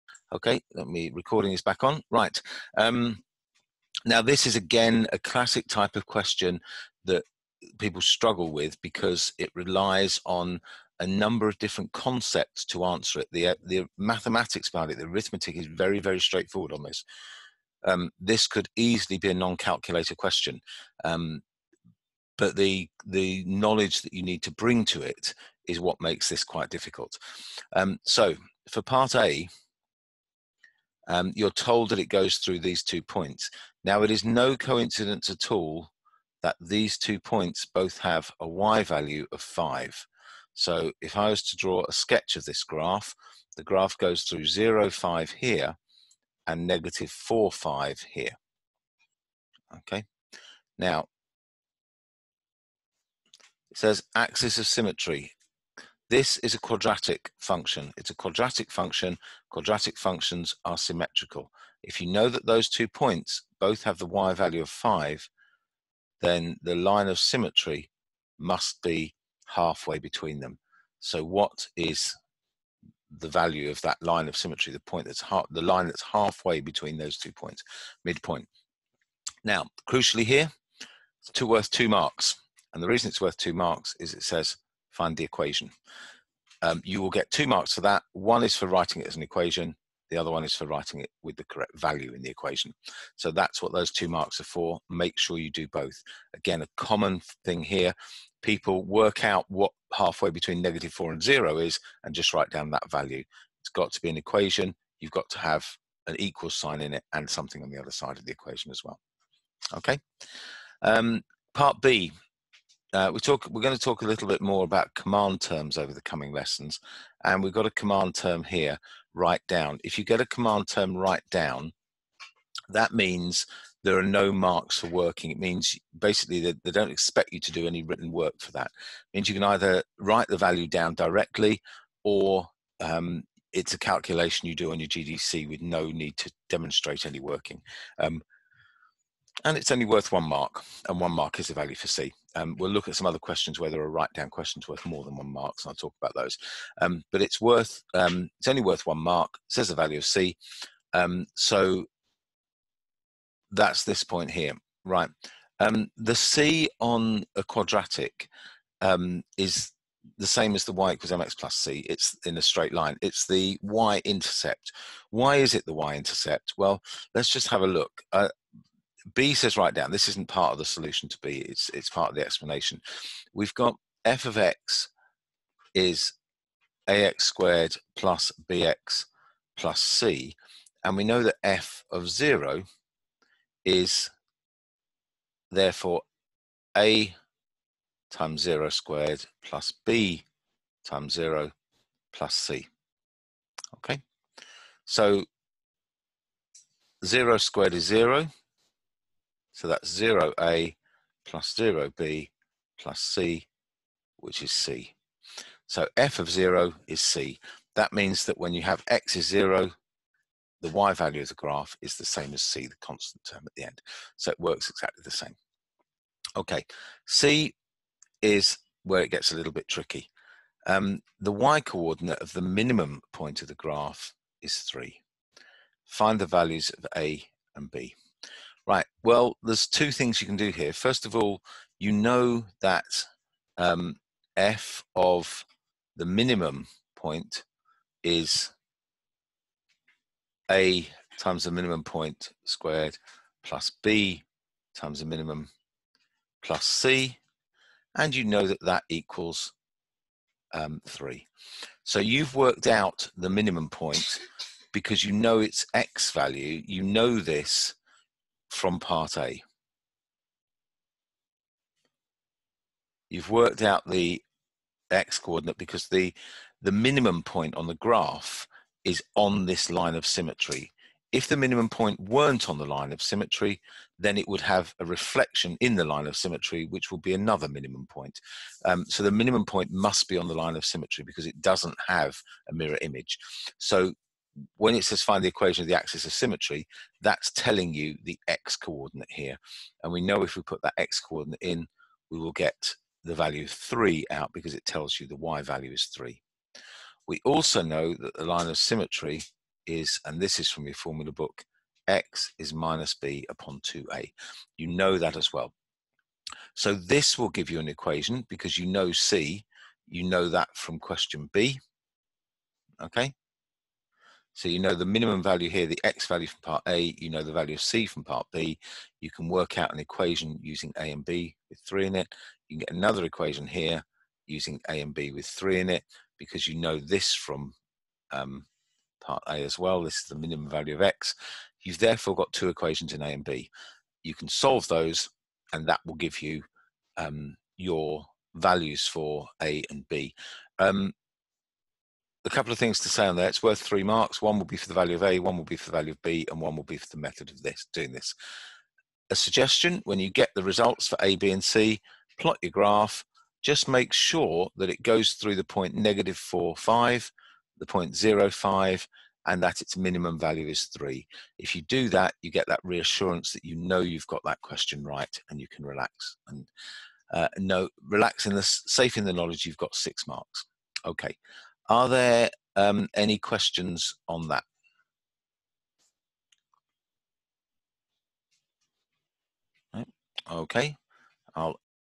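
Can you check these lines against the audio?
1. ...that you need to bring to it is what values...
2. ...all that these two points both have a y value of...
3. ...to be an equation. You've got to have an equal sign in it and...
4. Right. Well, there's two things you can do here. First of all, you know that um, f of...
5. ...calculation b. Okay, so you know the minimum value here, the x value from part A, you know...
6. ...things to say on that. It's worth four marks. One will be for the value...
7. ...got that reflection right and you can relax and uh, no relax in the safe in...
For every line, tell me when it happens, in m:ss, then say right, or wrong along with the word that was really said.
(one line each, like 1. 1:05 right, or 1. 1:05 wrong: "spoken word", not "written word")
1. 0:24 wrong: "makes", not "values"
2. 0:35 right
3. 1:43 right
4. 3:48 right
5. 5:10 wrong: "question", not "calculation"
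6. 5:42 wrong: "three", not "four"
7. 6:04 wrong: "question", not "reflection".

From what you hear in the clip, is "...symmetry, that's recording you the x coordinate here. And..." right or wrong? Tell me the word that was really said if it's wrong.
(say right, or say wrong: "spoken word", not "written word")
wrong: "telling", not "recording".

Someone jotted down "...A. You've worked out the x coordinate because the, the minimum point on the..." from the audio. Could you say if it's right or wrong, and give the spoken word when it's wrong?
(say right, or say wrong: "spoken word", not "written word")
right.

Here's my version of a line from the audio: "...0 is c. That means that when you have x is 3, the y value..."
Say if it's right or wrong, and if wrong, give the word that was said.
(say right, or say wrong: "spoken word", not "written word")
wrong: "0", not "3".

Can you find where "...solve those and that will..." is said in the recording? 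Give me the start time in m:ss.
5:34.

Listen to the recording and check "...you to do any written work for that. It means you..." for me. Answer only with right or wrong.
right.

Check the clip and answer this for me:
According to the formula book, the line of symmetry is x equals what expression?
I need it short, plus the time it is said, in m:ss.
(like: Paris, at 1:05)
minus b upon 2a, at 5:02.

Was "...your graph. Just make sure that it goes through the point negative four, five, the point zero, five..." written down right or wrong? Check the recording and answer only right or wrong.
right.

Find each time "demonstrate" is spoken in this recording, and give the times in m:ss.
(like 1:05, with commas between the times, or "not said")
2:16.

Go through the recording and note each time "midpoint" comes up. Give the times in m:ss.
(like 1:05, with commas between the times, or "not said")
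1:18.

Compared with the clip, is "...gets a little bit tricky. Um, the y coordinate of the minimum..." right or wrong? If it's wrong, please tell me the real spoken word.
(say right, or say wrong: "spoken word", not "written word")
right.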